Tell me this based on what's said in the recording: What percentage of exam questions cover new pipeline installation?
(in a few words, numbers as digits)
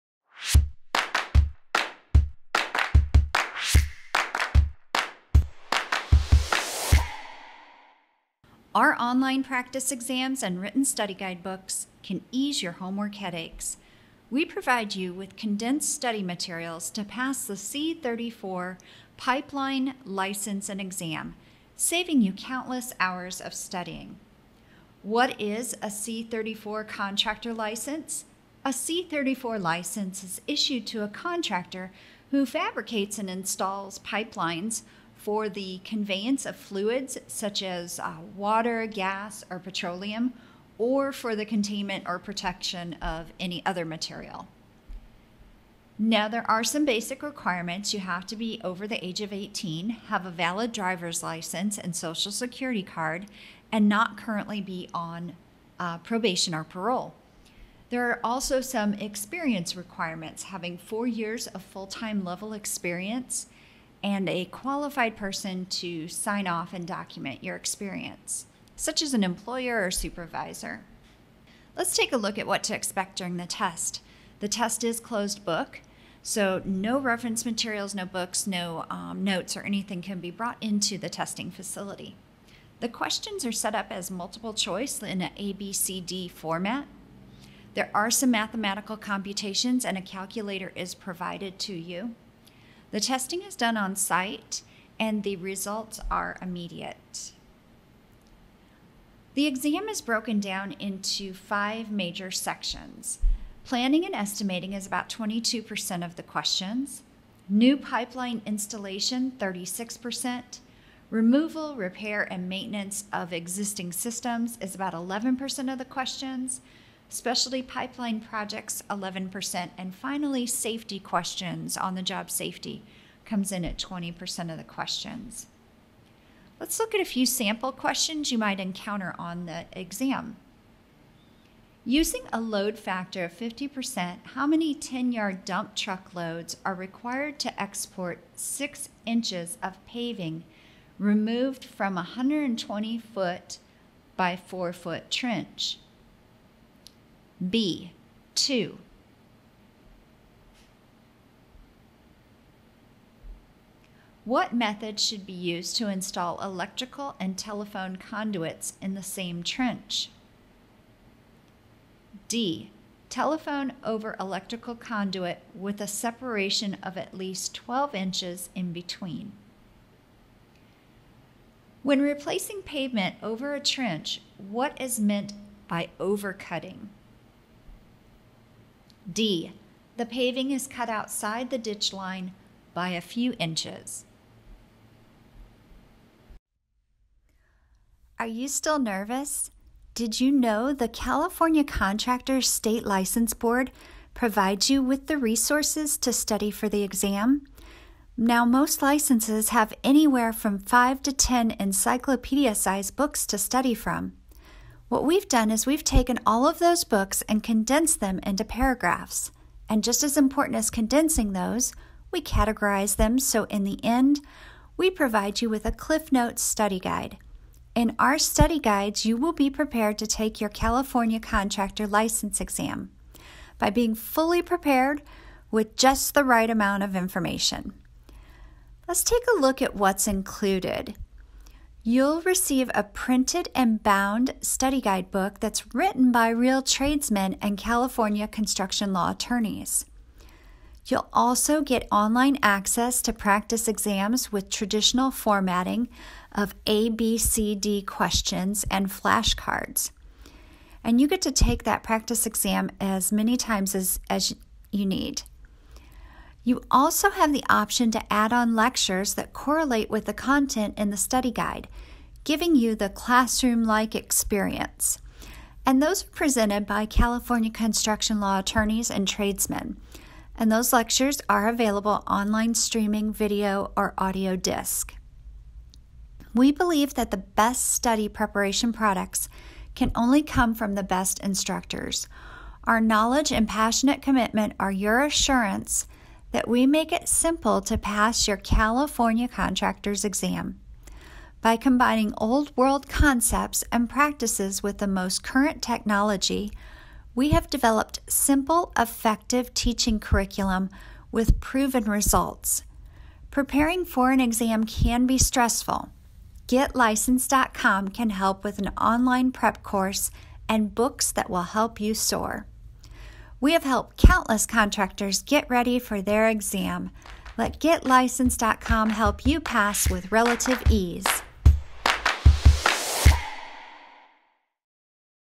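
36%.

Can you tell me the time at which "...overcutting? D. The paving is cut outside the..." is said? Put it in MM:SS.
02:55.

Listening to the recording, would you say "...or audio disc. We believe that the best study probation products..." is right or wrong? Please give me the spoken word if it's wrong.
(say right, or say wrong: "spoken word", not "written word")
wrong: "preparation", not "probation".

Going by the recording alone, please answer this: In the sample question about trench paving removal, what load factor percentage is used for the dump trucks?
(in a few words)
50%.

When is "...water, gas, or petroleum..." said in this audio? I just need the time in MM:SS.
00:38.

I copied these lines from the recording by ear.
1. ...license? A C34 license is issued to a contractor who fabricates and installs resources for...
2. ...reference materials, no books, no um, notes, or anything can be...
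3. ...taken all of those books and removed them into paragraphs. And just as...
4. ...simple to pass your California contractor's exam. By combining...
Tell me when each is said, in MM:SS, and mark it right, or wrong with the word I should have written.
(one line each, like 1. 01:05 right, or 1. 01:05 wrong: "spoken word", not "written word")
1. 00:27 wrong: "pipelines", not "resources"
2. 01:16 right
3. 03:25 wrong: "condensed", not "removed"
4. 04:47 right.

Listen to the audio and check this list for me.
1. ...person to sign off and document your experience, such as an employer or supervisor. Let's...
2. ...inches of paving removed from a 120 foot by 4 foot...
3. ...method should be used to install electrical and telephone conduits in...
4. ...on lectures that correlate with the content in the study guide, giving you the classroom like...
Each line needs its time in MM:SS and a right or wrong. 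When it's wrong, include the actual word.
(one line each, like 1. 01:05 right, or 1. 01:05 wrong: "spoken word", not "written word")
1. 01:05 right
2. 02:19 right
3. 02:34 right
4. 04:18 right.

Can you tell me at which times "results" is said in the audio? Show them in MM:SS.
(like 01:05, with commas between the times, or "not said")
01:35, 05:01.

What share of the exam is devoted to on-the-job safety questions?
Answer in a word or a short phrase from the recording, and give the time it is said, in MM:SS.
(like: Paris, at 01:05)
20%, at 02:03.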